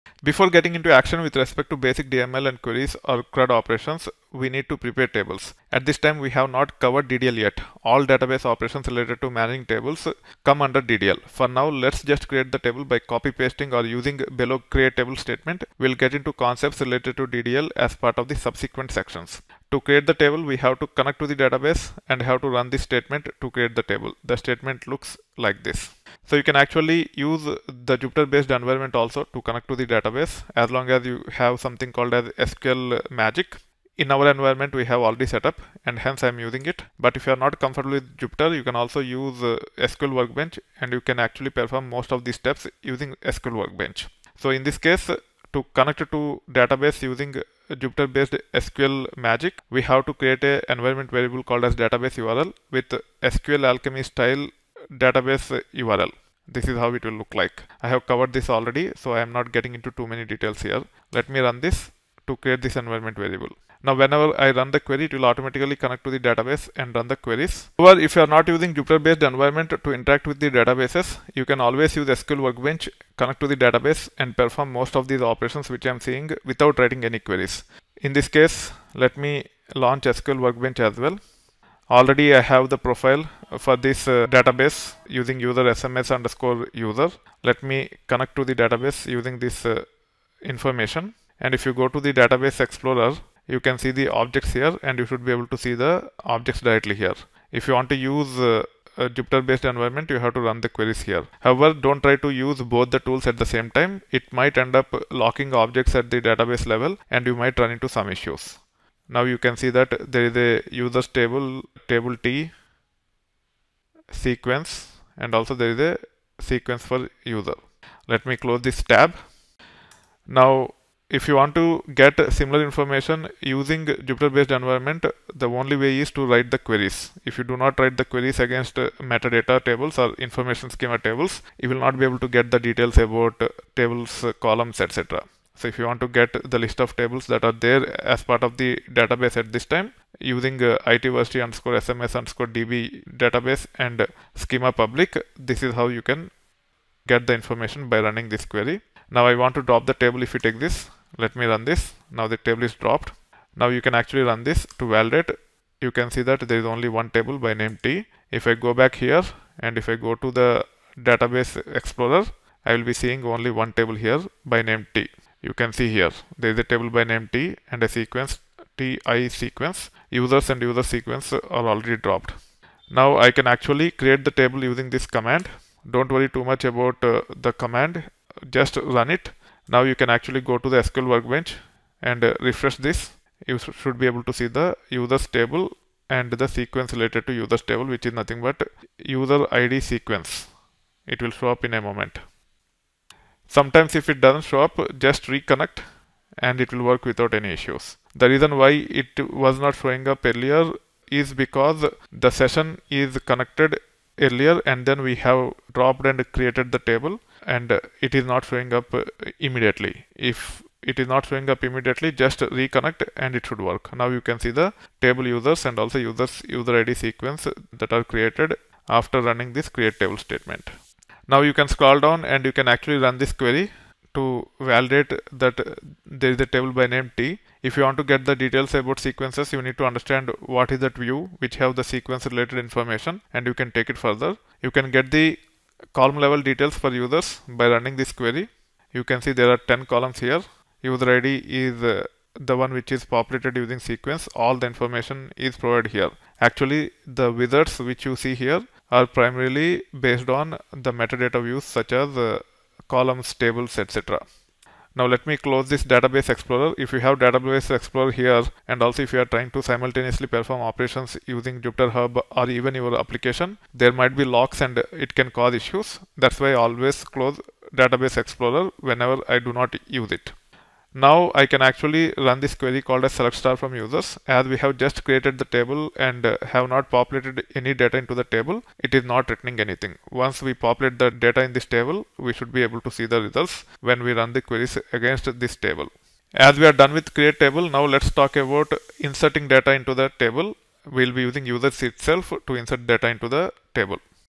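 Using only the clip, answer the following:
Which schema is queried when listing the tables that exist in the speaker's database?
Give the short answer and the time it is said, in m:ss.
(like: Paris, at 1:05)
public, at 2:24.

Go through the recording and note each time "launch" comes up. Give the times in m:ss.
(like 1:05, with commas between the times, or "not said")
1:19.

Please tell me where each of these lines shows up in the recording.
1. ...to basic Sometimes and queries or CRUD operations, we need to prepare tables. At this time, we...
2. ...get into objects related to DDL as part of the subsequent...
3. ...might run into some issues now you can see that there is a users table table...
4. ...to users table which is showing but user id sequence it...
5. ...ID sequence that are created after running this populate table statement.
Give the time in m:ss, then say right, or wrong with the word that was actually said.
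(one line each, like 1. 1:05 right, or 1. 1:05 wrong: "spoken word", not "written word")
1. 0:01 wrong: "DML", not "Sometimes"
2. 0:15 wrong: "concepts", not "objects"
3. 1:47 right
4. 3:07 wrong: "nothing", not "showing"
5. 3:36 wrong: "create", not "populate".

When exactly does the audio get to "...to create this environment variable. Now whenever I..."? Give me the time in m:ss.
1:02.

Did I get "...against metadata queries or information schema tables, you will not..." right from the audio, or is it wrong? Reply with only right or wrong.
wrong.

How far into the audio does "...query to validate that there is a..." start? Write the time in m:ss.
3:43.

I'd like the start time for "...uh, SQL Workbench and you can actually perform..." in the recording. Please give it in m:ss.
0:39.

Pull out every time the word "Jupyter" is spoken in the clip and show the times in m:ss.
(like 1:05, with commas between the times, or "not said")
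0:27, 0:38, 0:47, 1:08, 1:39, 2:03, 4:21.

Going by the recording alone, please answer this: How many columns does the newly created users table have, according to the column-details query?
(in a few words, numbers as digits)
10.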